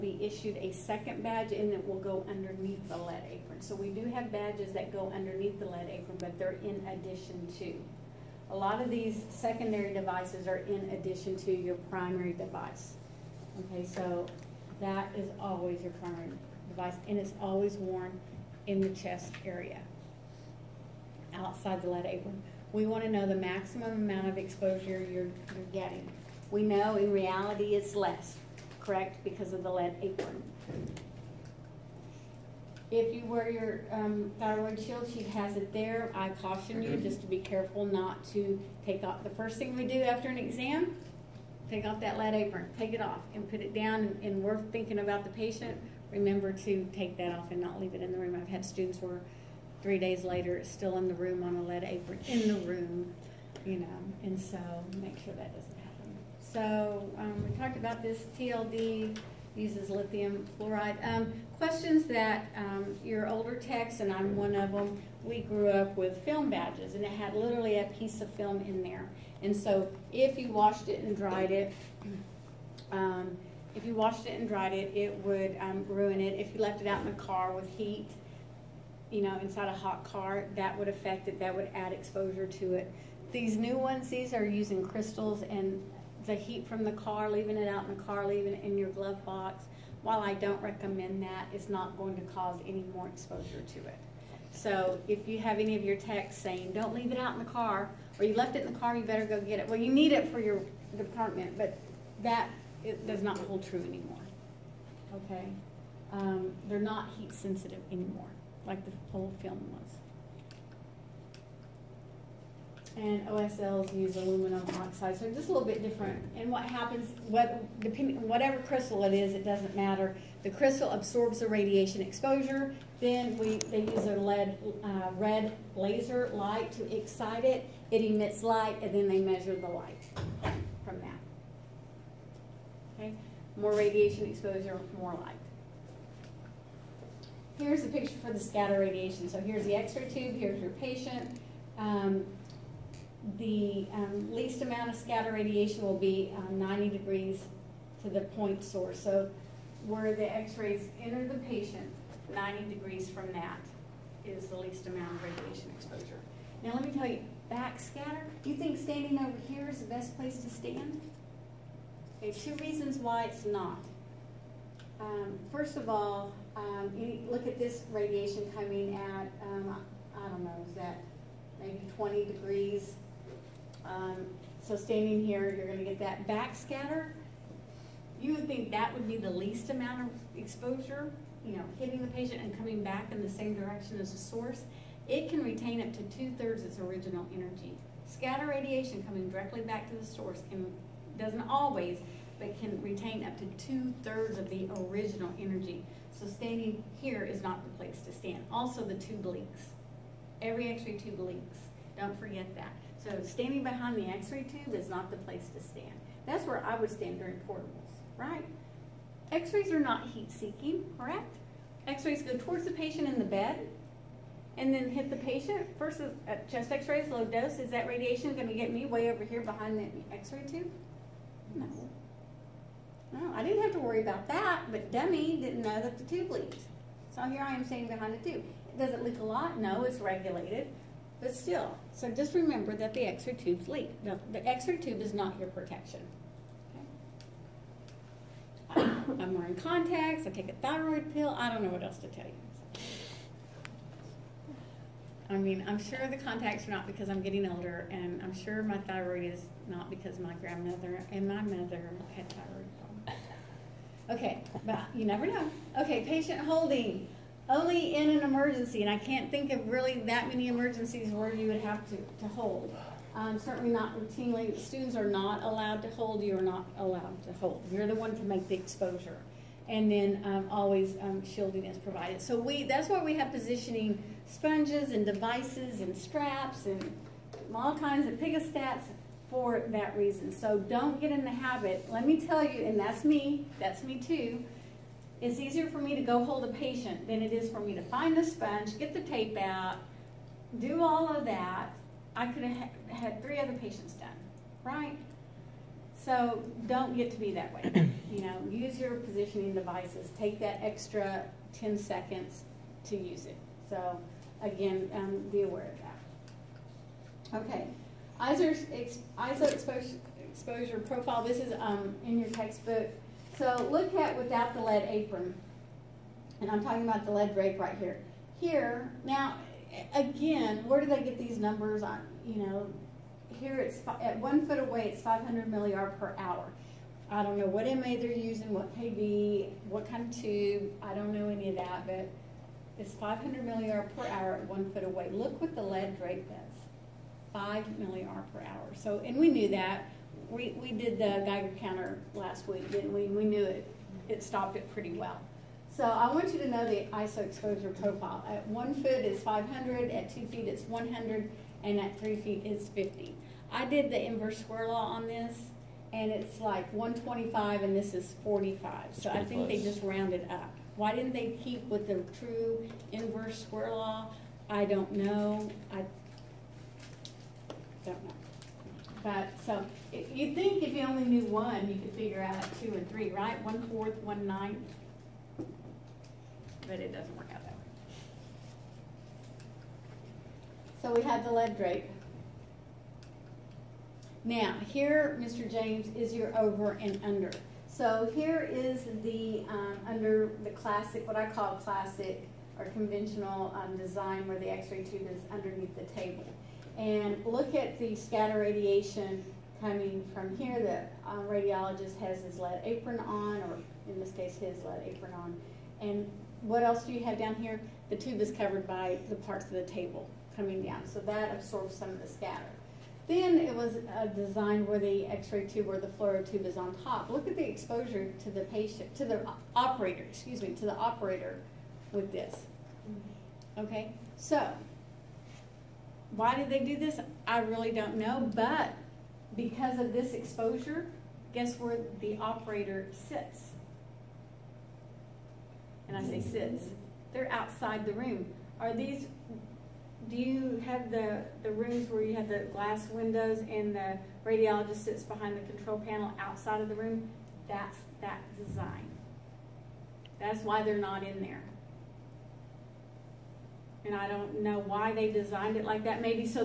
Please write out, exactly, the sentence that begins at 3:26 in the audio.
That's where I would stand during portables, right?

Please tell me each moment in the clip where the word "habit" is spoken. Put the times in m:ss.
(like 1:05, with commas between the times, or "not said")
4:41.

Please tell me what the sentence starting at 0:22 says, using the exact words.
We want to know the maximum amount of exposure you're, you're getting.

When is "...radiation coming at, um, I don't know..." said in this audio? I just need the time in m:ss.
2:47.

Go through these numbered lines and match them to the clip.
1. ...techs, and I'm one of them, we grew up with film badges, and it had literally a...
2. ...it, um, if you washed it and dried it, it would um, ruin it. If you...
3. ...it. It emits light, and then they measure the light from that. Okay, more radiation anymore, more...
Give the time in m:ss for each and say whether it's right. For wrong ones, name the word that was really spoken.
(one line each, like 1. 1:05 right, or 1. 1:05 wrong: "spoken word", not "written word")
1. 1:03 right
2. 1:11 right
3. 2:07 wrong: "exposure", not "anymore".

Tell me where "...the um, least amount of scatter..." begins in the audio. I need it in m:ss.
2:23.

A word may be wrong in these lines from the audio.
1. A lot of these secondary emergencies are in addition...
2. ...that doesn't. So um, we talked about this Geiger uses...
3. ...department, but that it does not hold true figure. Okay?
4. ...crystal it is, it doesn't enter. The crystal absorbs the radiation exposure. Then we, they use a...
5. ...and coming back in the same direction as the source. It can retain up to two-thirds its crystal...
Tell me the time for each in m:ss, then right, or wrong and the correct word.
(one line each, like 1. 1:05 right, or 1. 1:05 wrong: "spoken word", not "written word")
1. 0:08 wrong: "devices", not "emergencies"
2. 0:55 wrong: "TLD", not "Geiger"
3. 1:40 wrong: "anymore", not "figure"
4. 1:58 wrong: "matter", not "enter"
5. 3:02 wrong: "original", not "crystal".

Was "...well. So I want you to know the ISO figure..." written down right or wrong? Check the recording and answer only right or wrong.
wrong.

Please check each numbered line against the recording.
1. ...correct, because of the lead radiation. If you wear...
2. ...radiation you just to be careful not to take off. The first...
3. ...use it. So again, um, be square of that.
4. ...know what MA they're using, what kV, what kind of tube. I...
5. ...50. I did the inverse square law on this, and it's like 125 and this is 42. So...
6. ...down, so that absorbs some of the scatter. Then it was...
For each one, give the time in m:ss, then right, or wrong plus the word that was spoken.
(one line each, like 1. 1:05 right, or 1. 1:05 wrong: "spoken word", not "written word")
1. 0:28 wrong: "apron", not "radiation"
2. 0:36 wrong: "caution", not "radiation"
3. 5:02 wrong: "aware", not "square"
4. 5:27 right
5. 5:52 wrong: "45", not "42"
6. 6:50 right.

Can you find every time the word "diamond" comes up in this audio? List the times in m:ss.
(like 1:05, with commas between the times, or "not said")
not said.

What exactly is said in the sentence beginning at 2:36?
Now let me tell you, backscatter, do you think standing over here is the best place to stand?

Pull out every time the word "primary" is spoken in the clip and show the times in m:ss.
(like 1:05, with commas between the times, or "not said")
0:11, 0:15.